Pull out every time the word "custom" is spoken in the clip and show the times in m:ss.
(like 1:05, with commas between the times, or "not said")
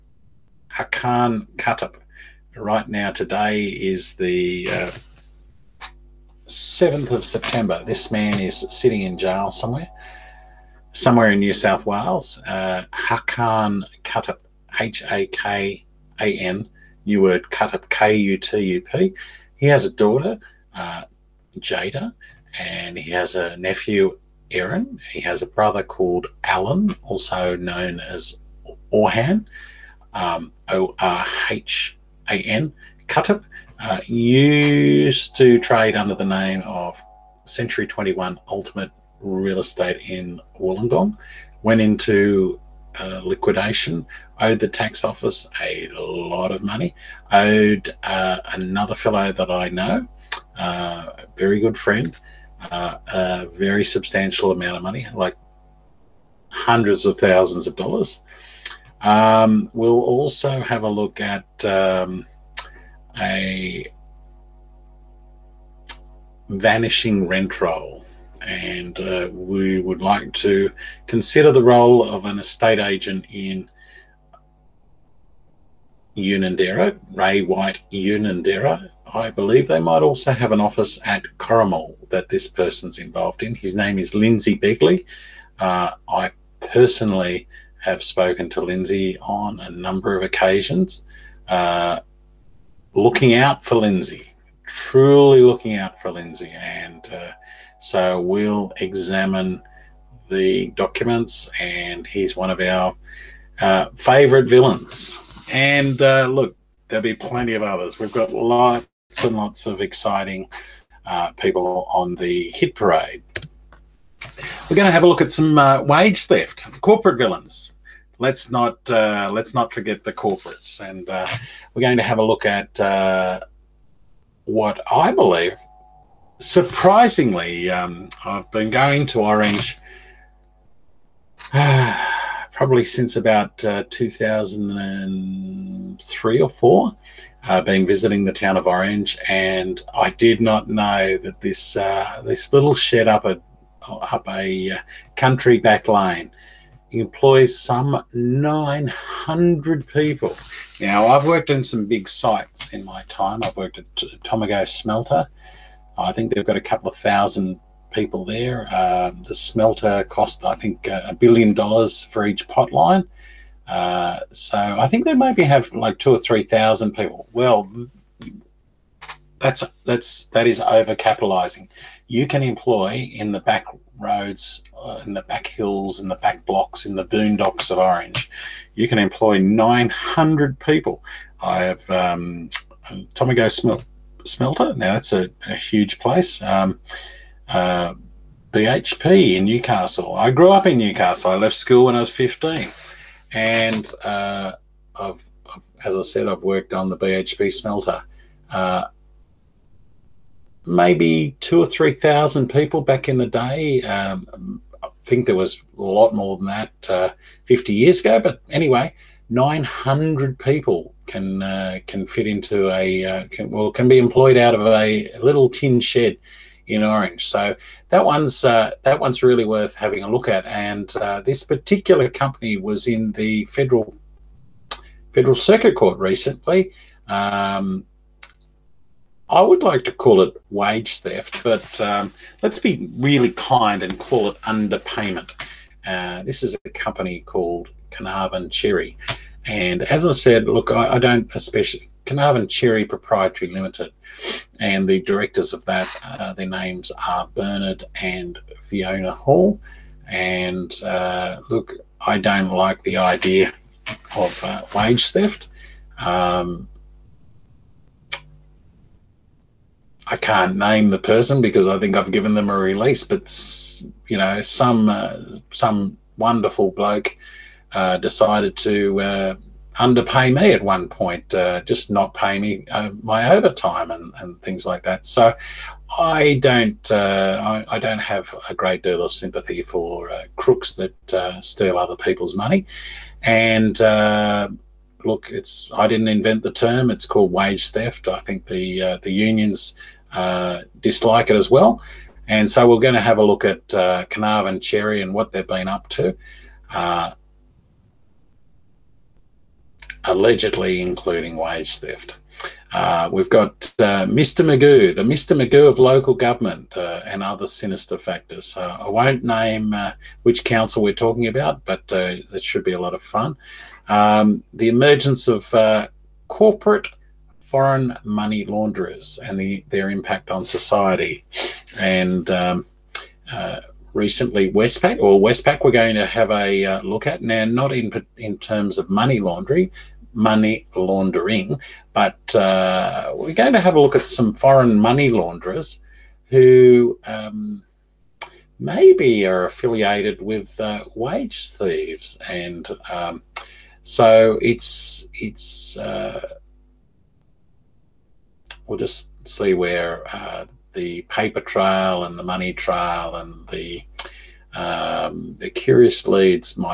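not said.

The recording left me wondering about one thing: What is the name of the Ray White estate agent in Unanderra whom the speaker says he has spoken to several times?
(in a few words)
Lindsay Begley.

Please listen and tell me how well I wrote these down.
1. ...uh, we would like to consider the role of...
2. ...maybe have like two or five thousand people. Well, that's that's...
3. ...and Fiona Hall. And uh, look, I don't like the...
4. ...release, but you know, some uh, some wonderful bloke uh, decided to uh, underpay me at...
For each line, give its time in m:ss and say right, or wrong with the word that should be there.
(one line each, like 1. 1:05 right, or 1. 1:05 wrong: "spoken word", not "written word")
1. 1:08 right
2. 2:45 wrong: "three", not "five"
3. 4:07 right
4. 4:22 right.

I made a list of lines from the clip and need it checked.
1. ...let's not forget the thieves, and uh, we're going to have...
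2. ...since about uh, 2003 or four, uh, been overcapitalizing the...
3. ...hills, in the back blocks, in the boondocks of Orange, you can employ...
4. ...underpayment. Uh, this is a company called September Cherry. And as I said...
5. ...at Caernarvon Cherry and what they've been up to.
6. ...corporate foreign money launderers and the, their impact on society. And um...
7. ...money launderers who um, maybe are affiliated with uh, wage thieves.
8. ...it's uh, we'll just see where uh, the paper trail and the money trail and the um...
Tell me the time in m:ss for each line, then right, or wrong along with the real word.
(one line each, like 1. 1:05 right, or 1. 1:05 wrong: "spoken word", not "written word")
1. 1:59 wrong: "corporates", not "thieves"
2. 2:12 wrong: "visiting", not "overcapitalizing"
3. 2:55 right
4. 3:54 wrong: "Caernarvon", not "September"
5. 4:53 right
6. 5:16 right
7. 5:34 right
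8. 5:45 right.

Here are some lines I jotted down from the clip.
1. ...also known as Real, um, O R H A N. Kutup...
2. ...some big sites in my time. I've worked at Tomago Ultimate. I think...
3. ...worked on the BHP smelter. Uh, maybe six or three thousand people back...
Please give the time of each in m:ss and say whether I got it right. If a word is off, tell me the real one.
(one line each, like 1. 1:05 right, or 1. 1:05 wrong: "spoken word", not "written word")
1. 0:27 wrong: "Orhan", not "Real"
2. 2:31 wrong: "Smelter", not "Ultimate"
3. 3:16 wrong: "two", not "six".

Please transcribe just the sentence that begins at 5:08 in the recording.
I won't name uh, which council we're talking about, but uh, that should be a lot of fun.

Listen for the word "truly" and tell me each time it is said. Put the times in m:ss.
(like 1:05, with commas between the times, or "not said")
1:34.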